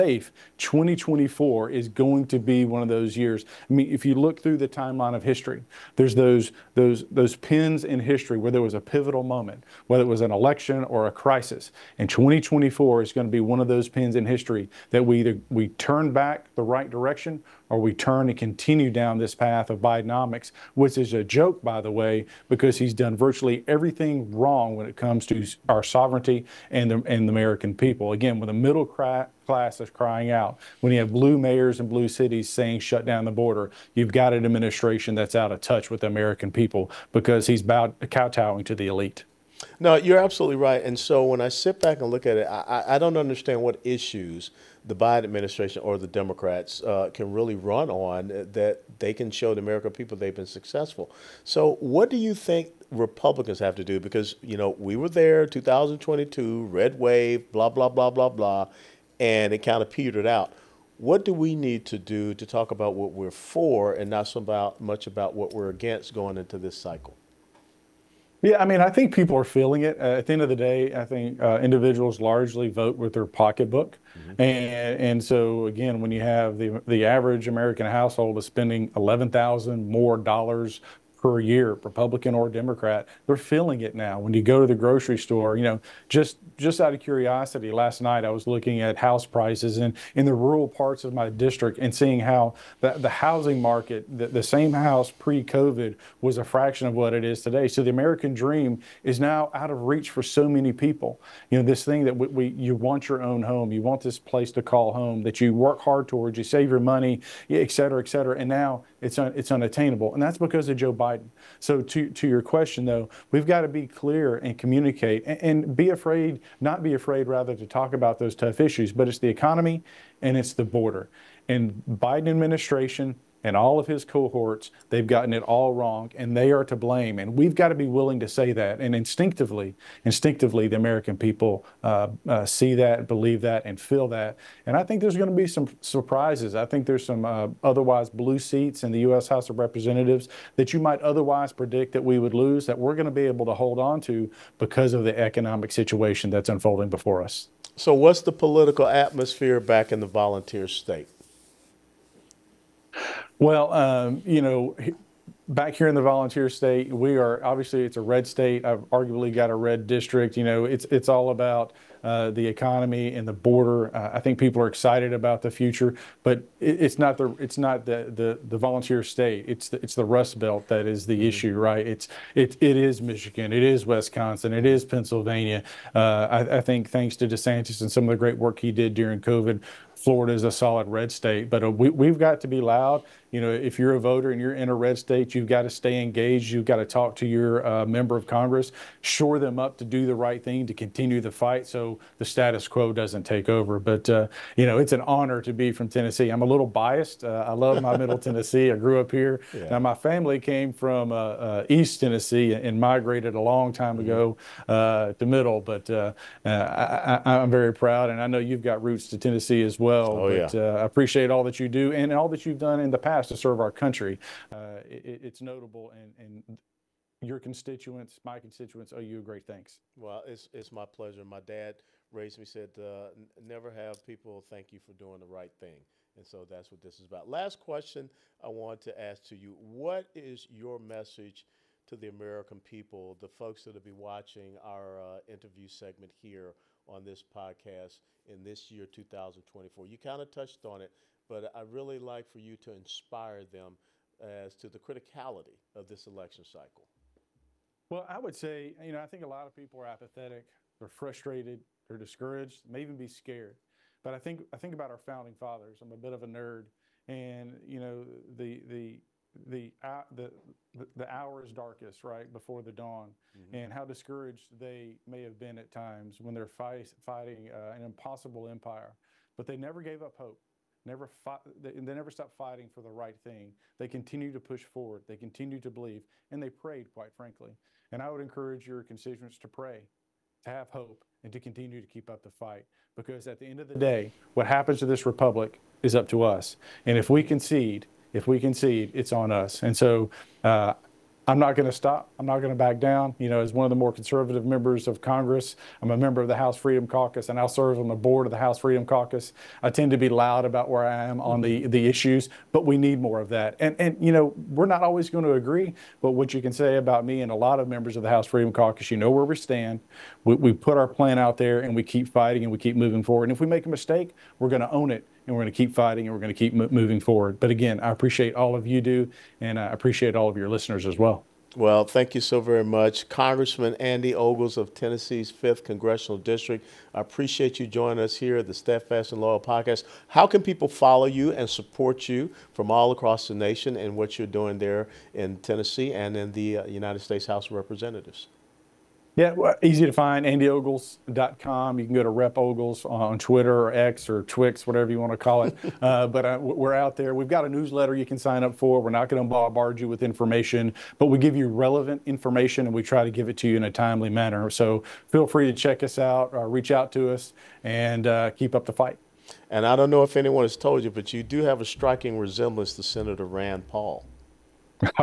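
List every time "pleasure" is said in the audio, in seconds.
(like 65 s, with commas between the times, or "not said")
220 s.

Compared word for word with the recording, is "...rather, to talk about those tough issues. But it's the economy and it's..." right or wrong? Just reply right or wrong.
right.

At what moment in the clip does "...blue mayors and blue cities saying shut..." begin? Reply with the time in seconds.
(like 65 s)
31 s.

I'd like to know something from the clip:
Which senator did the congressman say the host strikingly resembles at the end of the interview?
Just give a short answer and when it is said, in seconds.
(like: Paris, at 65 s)
Rand Paul, at 363 s.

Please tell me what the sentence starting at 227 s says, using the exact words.
Last question I want to ask to you: What is your message?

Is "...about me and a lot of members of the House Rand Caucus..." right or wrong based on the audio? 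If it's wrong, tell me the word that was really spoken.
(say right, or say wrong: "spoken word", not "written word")
wrong: "Freedom", not "Rand".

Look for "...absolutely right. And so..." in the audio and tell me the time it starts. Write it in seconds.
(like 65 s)
40 s.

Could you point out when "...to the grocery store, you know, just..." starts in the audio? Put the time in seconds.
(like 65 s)
84 s.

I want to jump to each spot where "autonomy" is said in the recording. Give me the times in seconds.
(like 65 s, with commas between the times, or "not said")
not said.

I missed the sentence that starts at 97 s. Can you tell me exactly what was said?
So the American dream is now out of reach for so many people.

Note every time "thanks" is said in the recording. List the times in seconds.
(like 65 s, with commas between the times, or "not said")
176 s, 219 s, 224 s, 321 s.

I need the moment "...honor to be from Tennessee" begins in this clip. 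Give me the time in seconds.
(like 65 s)
195 s.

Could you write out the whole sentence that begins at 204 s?
ago to middle, but I, am very proud.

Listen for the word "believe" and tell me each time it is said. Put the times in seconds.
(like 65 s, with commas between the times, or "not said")
133 s, 275 s.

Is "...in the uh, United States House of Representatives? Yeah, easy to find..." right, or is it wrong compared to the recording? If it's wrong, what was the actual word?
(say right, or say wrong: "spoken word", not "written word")
right.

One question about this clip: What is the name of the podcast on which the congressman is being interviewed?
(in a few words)
Steadfast and Loyal Podcast.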